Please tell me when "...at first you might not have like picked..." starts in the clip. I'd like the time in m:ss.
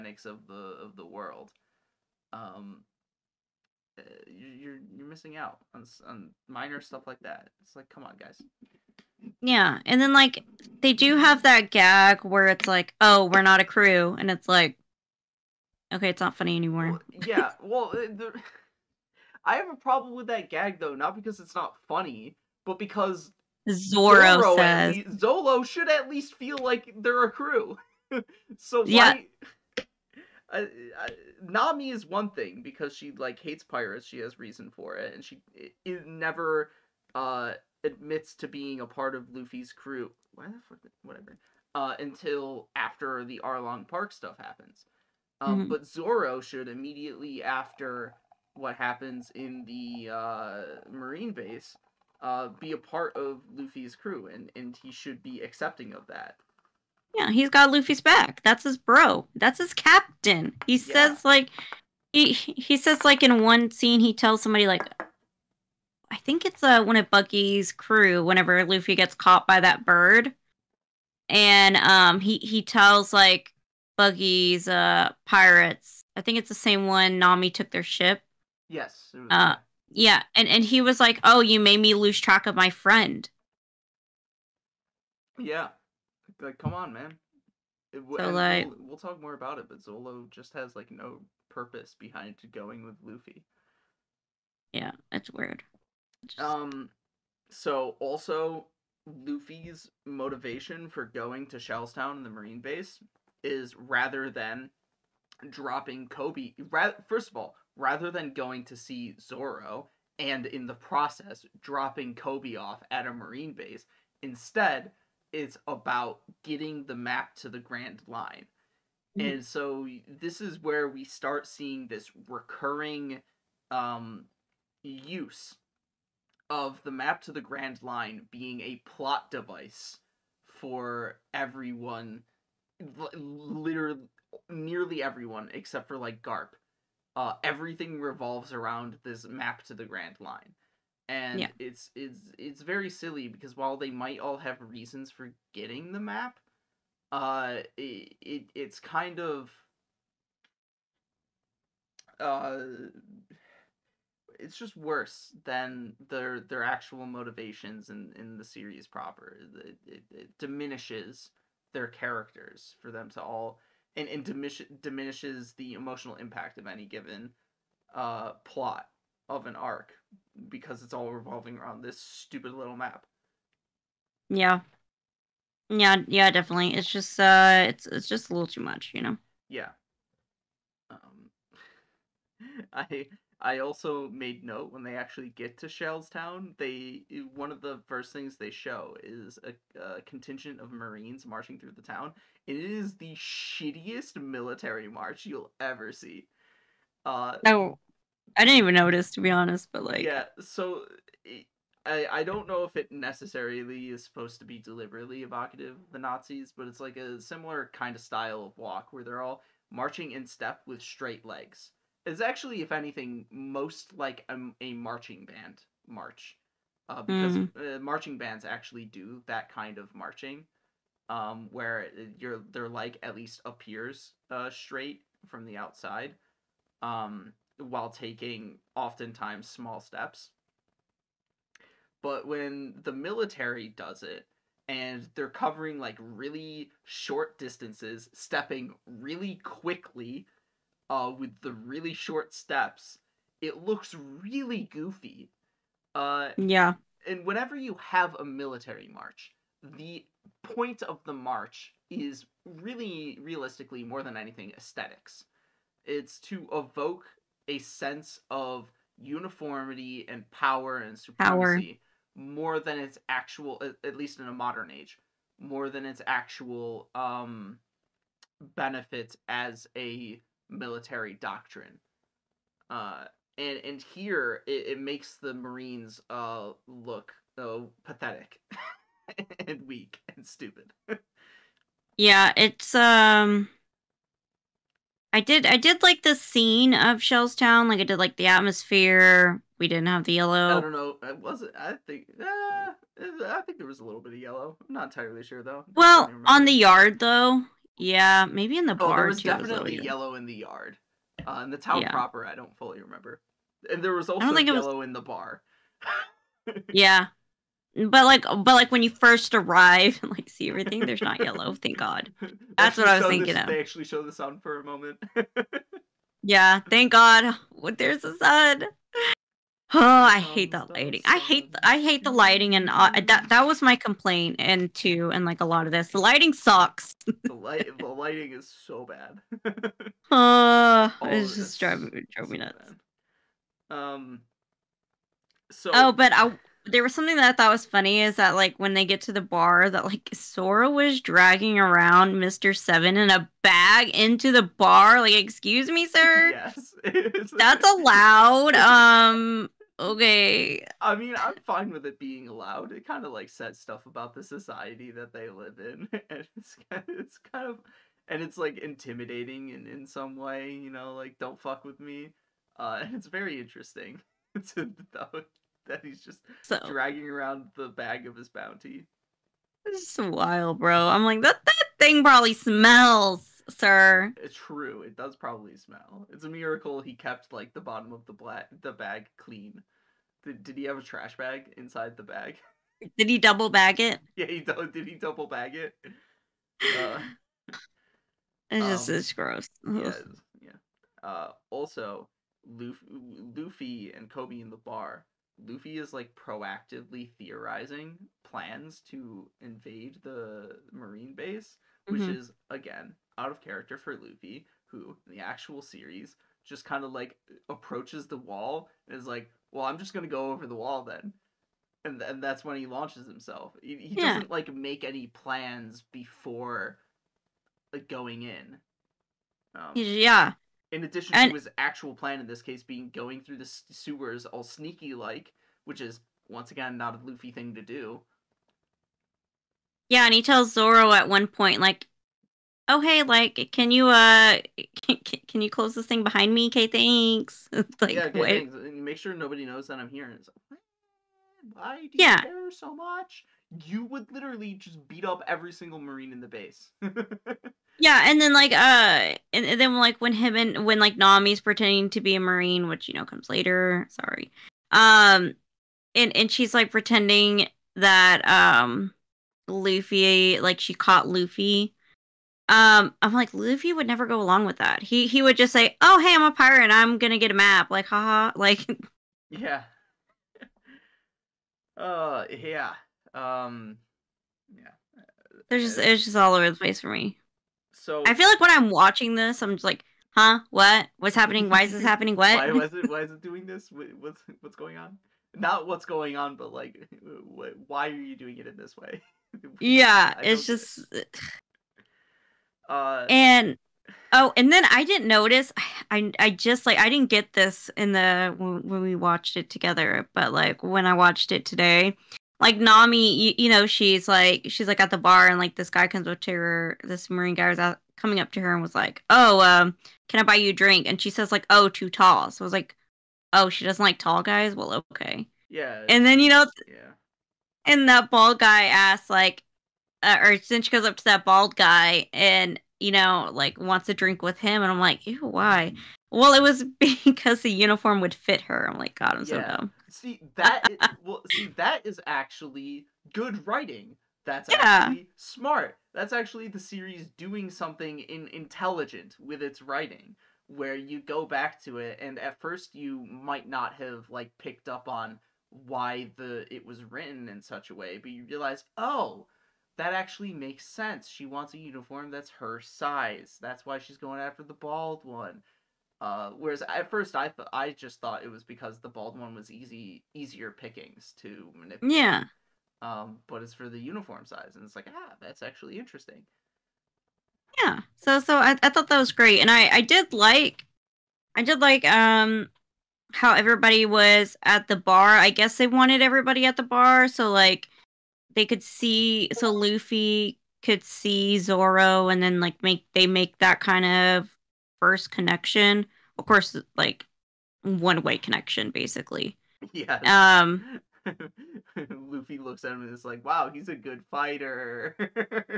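9:02.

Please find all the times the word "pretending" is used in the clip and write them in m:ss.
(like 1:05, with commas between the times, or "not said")
7:31, 7:36.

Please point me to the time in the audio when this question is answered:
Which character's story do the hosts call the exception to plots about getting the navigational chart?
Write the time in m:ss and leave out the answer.
2:16.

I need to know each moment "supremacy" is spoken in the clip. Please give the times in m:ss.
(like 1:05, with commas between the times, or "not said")
4:20.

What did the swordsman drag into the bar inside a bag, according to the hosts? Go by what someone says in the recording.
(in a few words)
Mister Seven.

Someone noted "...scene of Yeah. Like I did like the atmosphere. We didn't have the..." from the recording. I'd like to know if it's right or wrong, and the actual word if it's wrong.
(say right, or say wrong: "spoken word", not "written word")
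wrong: "Shellstown", not "Yeah".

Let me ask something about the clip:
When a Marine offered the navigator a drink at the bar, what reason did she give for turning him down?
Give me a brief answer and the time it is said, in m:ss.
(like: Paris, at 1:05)
Too tall, at 8:31.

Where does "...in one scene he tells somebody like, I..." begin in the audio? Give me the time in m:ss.
1:03.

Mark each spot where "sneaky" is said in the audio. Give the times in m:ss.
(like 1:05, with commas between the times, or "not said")
7:04.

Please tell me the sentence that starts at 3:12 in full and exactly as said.
It is the shittiest military march you'll ever see.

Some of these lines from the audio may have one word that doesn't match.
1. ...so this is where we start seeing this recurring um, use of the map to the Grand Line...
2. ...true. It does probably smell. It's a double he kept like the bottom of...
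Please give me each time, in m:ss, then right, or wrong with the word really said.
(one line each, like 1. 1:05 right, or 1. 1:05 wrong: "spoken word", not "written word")
1. 1:59 right
2. 6:14 wrong: "miracle", not "double".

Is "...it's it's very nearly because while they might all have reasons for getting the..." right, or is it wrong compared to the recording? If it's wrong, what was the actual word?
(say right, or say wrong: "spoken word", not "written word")
wrong: "silly", not "nearly".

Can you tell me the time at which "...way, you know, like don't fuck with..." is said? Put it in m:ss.
6:00.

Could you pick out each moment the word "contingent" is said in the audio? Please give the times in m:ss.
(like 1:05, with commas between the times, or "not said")
3:10.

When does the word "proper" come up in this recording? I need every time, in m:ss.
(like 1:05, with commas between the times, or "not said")
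2:38, 5:01.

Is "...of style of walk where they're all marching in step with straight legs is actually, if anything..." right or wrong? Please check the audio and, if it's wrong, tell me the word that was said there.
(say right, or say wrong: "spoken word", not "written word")
right.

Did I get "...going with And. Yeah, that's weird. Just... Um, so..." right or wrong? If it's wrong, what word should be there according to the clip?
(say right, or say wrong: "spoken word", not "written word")
wrong: "Luffy", not "And".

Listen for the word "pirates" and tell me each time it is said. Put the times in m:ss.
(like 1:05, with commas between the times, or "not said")
0:33, 1:15, 7:46.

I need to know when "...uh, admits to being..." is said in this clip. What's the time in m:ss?
0:37.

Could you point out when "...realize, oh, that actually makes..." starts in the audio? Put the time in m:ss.
9:08.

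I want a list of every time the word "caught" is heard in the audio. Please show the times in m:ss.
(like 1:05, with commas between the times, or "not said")
1:09, 7:40.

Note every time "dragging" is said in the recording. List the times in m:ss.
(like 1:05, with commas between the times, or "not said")
5:40, 6:06.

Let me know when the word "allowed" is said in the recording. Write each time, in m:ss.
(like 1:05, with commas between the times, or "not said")
5:47, 5:52.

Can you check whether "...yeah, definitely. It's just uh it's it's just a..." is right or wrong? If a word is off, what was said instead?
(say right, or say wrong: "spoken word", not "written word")
right.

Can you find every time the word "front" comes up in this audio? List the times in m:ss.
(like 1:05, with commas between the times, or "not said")
not said.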